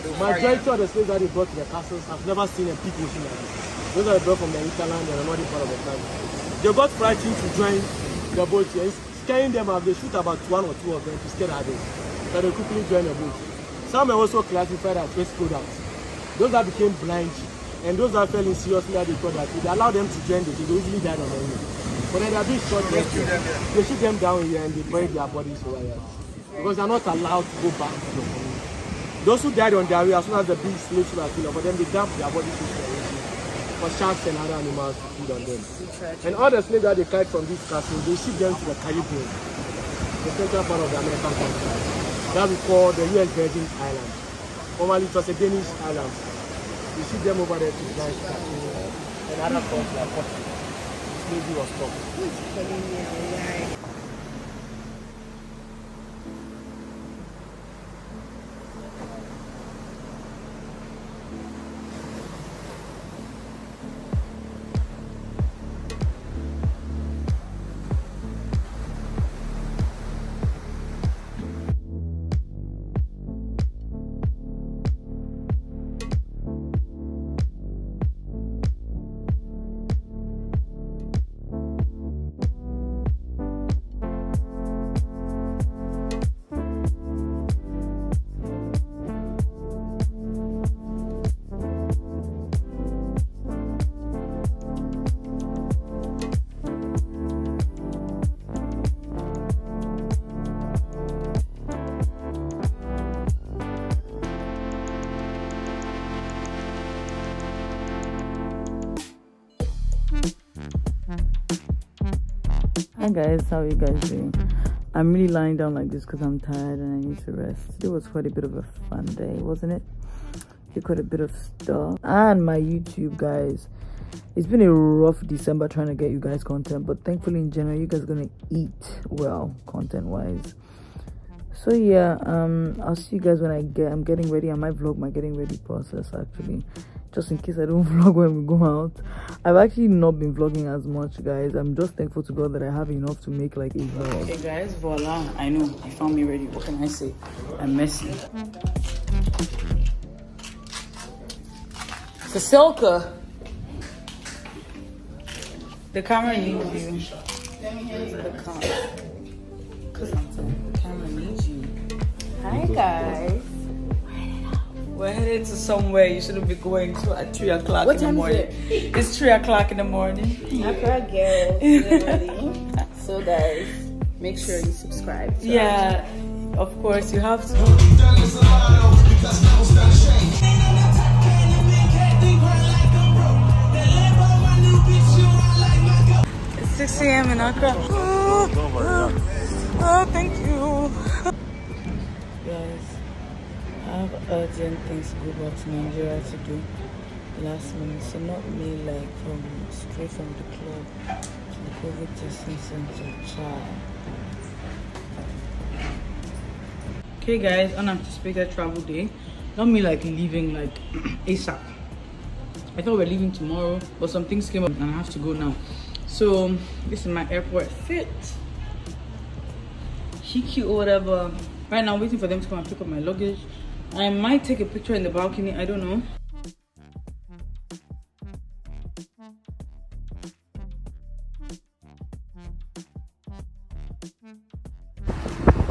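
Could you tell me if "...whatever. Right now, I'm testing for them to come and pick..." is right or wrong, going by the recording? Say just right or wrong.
wrong.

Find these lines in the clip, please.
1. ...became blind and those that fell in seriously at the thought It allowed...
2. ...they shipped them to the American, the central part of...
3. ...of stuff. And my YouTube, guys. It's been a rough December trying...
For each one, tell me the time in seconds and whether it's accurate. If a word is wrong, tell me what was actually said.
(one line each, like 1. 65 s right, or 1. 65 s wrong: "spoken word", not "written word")
1. 16 s right
2. 38 s wrong: "Caribbean", not "American"
3. 121 s right.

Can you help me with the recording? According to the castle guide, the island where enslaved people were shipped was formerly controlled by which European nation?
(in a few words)
Danish.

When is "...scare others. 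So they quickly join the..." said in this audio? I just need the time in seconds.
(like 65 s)
11 s.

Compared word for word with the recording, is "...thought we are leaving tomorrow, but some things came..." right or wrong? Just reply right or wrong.
right.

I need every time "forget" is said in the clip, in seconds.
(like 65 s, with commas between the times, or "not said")
not said.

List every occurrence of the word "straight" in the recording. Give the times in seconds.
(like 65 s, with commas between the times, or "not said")
199 s.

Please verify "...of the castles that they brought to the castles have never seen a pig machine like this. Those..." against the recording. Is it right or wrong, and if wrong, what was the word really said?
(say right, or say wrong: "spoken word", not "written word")
wrong: "slaves", not "castles".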